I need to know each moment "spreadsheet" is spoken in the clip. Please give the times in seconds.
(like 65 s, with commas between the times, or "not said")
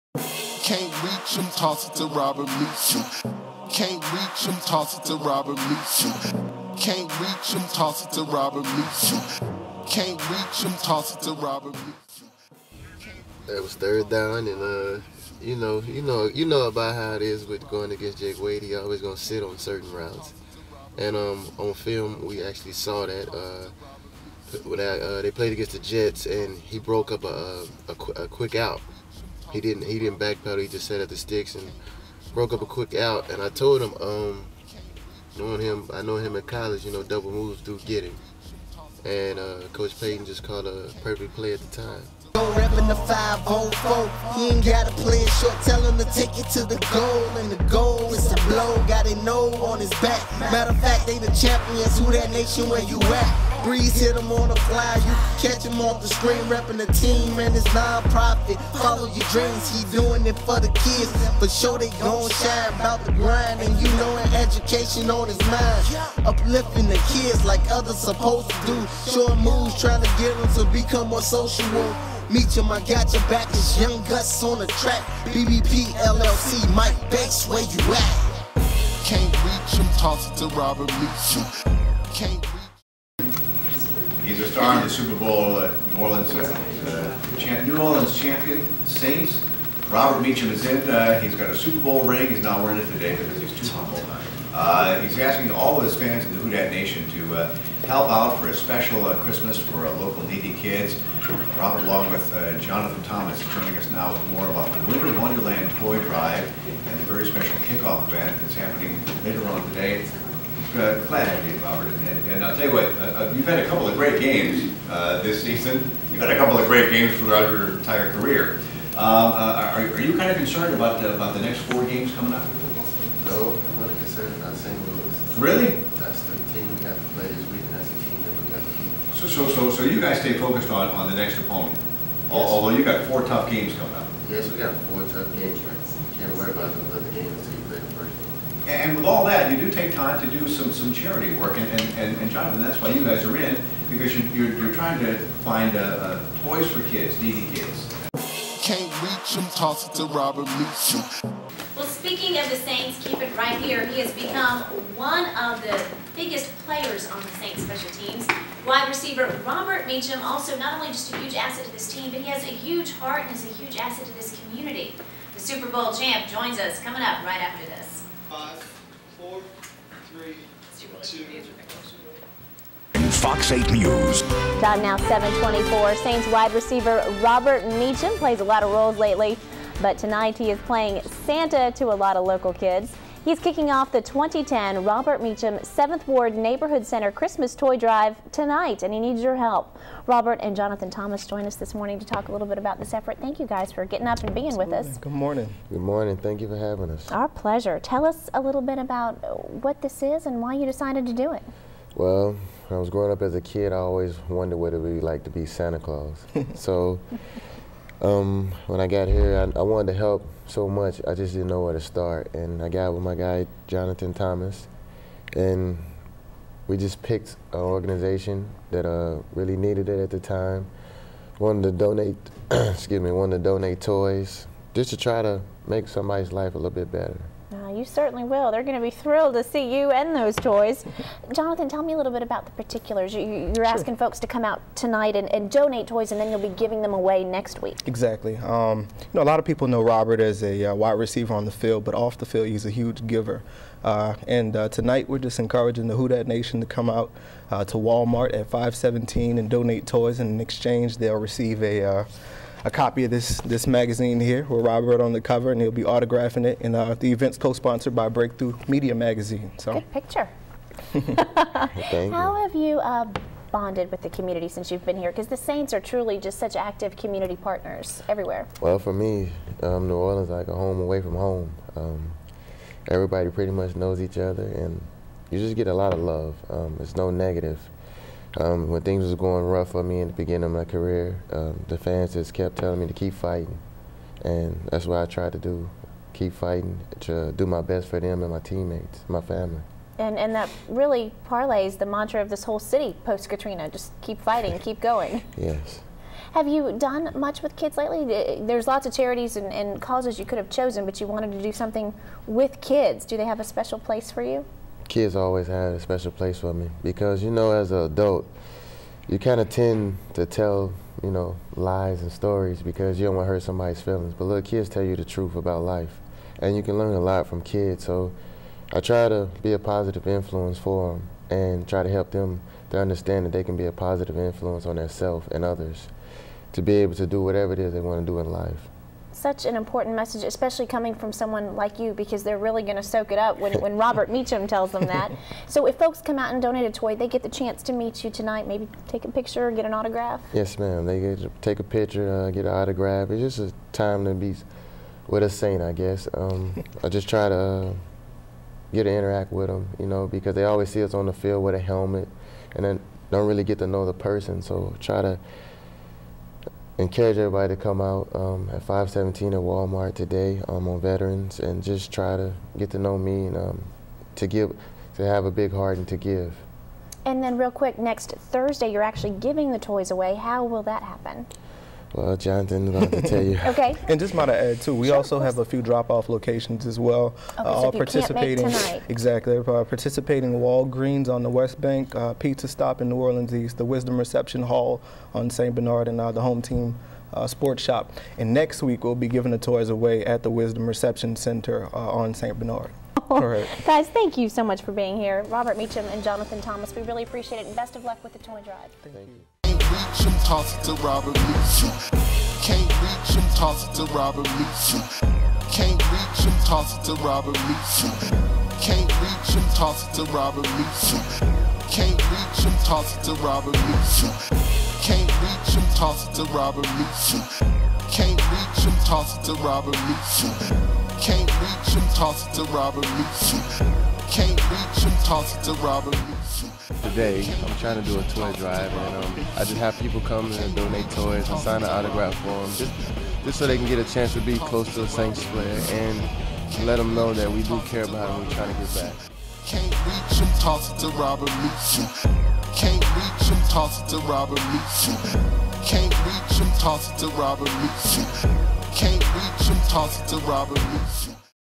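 not said.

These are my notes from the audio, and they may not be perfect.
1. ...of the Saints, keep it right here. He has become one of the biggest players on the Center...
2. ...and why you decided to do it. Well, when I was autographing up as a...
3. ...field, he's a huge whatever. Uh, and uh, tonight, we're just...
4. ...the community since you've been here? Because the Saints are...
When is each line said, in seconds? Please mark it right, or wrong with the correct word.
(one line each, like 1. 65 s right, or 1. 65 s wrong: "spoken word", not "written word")
1. 152 s wrong: "Saints", not "Center"
2. 200 s wrong: "growing", not "autographing"
3. 242 s wrong: "giver", not "whatever"
4. 264 s right.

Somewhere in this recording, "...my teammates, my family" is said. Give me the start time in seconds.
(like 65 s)
288 s.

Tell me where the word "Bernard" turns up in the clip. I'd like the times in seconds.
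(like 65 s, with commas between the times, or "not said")
385 s, 392 s.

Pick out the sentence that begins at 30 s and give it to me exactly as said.
He just sat at the sticks and broke up a quick out.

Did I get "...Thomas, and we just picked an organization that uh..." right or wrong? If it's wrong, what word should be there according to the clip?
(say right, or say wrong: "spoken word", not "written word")
right.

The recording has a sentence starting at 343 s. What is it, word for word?
It's just a time to be with a saint, I guess.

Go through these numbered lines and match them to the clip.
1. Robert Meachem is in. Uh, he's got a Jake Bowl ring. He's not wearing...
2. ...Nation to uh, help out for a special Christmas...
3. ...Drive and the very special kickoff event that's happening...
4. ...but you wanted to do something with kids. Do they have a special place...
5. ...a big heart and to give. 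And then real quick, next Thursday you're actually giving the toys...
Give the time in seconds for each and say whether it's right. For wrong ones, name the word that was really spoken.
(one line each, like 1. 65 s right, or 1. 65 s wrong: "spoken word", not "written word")
1. 89 s wrong: "Super", not "Jake"
2. 96 s right
3. 106 s right
4. 300 s right
5. 365 s right.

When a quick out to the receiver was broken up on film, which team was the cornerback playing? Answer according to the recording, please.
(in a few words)
Jets.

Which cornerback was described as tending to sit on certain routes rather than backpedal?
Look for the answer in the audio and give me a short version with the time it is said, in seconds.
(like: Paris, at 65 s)
Jake Wade, at 18 s.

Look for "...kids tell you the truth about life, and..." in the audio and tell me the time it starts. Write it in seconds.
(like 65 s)
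314 s.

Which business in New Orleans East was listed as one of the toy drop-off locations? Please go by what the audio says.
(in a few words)
Pizza Stop.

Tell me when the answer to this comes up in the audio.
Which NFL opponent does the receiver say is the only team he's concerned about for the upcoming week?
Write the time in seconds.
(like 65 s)
124 s.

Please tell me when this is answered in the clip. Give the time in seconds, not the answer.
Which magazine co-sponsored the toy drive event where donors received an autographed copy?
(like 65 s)
258 s.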